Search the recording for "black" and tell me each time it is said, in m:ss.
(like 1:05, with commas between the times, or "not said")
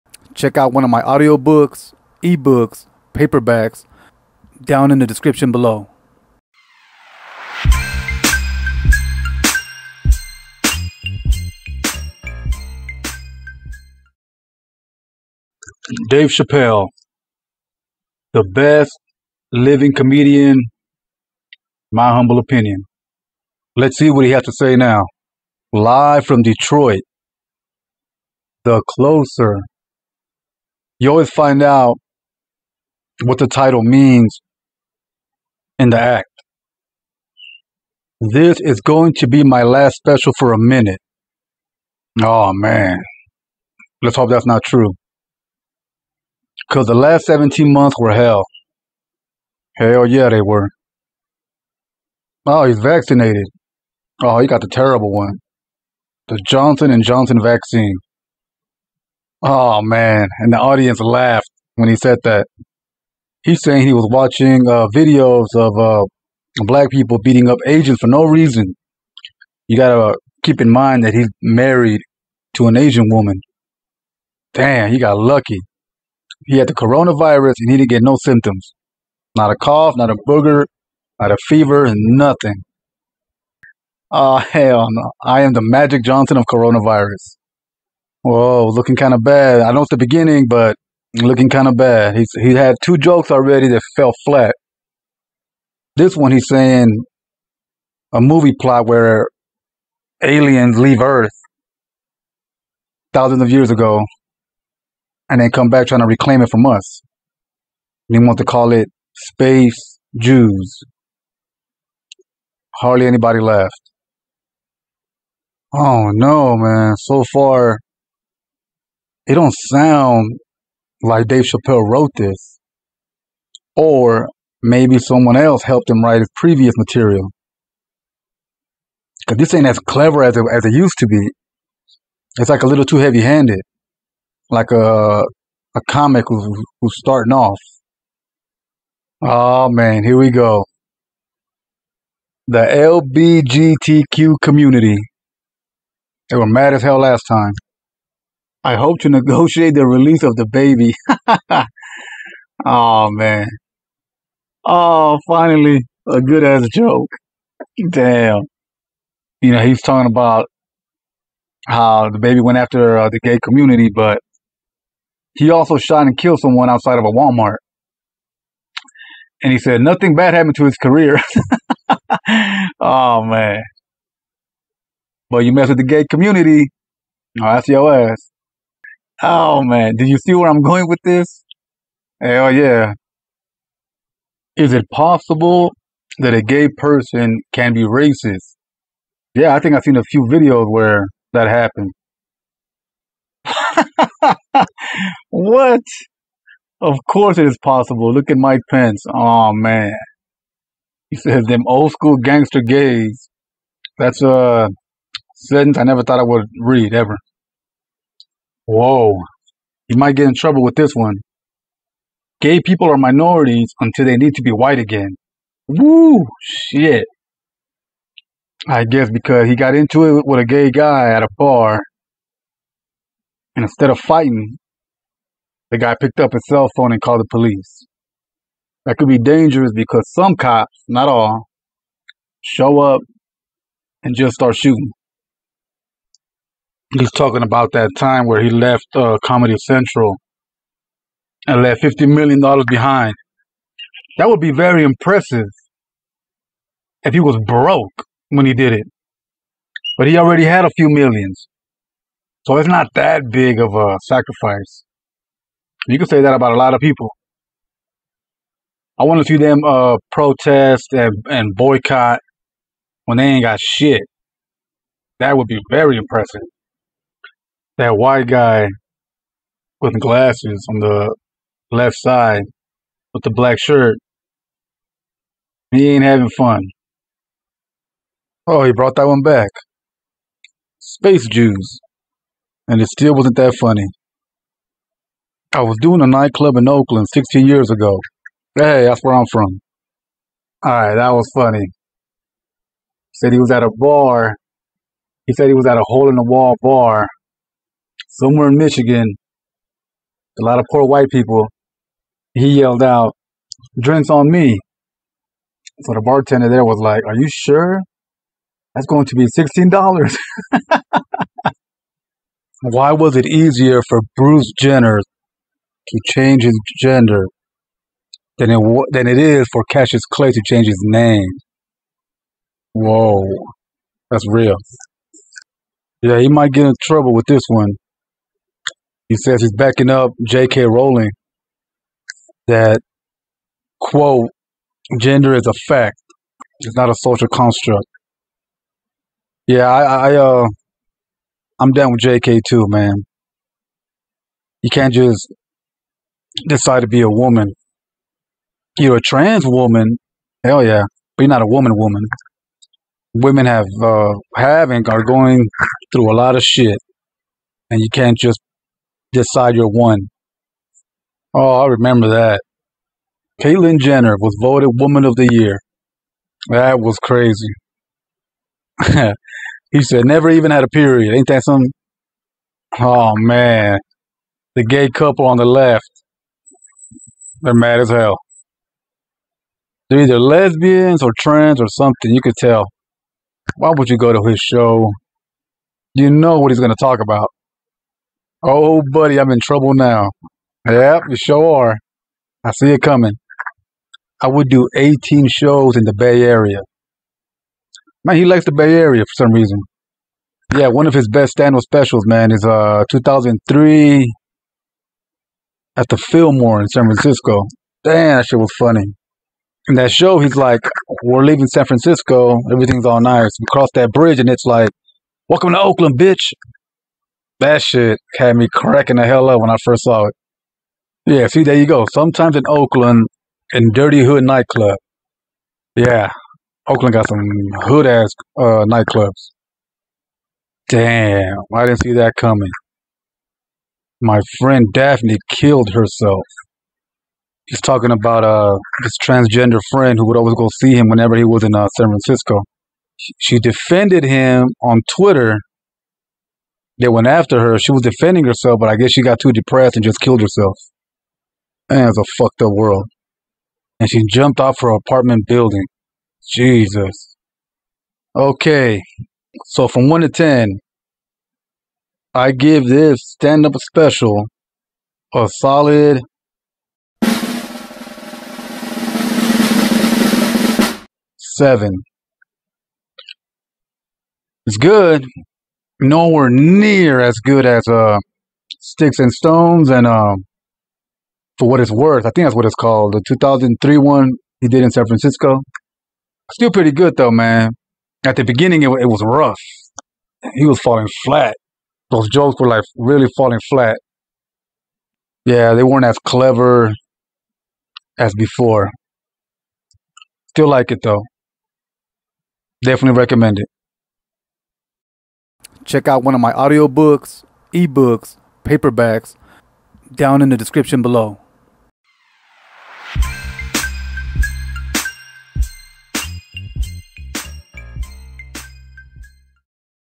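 1:06, 4:33.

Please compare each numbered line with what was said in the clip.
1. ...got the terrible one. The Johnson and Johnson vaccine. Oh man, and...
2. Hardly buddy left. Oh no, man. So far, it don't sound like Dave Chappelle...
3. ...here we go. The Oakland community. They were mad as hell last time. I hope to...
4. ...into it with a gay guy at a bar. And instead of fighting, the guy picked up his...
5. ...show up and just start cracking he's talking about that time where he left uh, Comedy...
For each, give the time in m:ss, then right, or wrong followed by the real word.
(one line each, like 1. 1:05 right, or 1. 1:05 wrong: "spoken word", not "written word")
1. 0:54 right
2. 1:52 wrong: "anybody", not "buddy"
3. 2:20 wrong: "LBGTQ", not "Oakland"
4. 3:39 right
5. 3:52 wrong: "shooting", not "cracking".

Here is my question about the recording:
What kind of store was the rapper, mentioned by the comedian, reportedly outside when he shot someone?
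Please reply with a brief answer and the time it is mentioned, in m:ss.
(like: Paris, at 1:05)
Walmart, at 2:47.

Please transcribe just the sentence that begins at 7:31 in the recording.
Man, it's a fucked up world.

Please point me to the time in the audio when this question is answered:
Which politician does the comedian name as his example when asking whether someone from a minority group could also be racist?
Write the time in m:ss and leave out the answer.
3:18.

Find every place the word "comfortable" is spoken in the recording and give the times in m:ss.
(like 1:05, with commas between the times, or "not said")
not said.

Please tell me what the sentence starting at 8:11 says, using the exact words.
Those jokes were like really falling flat.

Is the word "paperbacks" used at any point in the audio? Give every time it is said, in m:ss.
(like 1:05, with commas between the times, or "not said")
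0:03, 8:28.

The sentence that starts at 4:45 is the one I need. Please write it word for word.
I was doing a nightclub in Oakland 16 years ago.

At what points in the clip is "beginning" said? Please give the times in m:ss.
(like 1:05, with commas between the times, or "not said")
1:29, 8:08.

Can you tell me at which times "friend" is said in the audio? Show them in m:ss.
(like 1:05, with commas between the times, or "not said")
7:14, 7:19.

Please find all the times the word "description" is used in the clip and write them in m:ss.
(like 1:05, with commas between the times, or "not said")
0:05, 8:30.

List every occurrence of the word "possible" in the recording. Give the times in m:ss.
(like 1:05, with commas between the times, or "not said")
3:04, 3:17.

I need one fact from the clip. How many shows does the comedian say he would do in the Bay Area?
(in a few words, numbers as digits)
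18.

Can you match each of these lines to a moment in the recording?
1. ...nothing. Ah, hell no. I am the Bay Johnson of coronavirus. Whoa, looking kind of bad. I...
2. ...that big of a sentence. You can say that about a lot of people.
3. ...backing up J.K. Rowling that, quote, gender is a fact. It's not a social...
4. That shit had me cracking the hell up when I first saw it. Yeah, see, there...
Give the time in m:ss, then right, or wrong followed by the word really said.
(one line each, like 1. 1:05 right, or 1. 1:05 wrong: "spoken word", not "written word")
1. 1:22 wrong: "Magic", not "Bay"
2. 4:12 wrong: "sacrifice", not "sentence"
3. 5:29 right
4. 6:57 right.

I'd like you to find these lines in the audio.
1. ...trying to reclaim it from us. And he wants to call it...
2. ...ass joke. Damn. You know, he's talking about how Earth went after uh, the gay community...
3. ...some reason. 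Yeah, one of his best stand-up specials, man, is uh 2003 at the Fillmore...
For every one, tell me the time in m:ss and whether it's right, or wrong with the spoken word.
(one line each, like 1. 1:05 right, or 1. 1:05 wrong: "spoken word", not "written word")
1. 1:45 right
2. 2:36 wrong: "DaBaby", not "Earth"
3. 6:39 right.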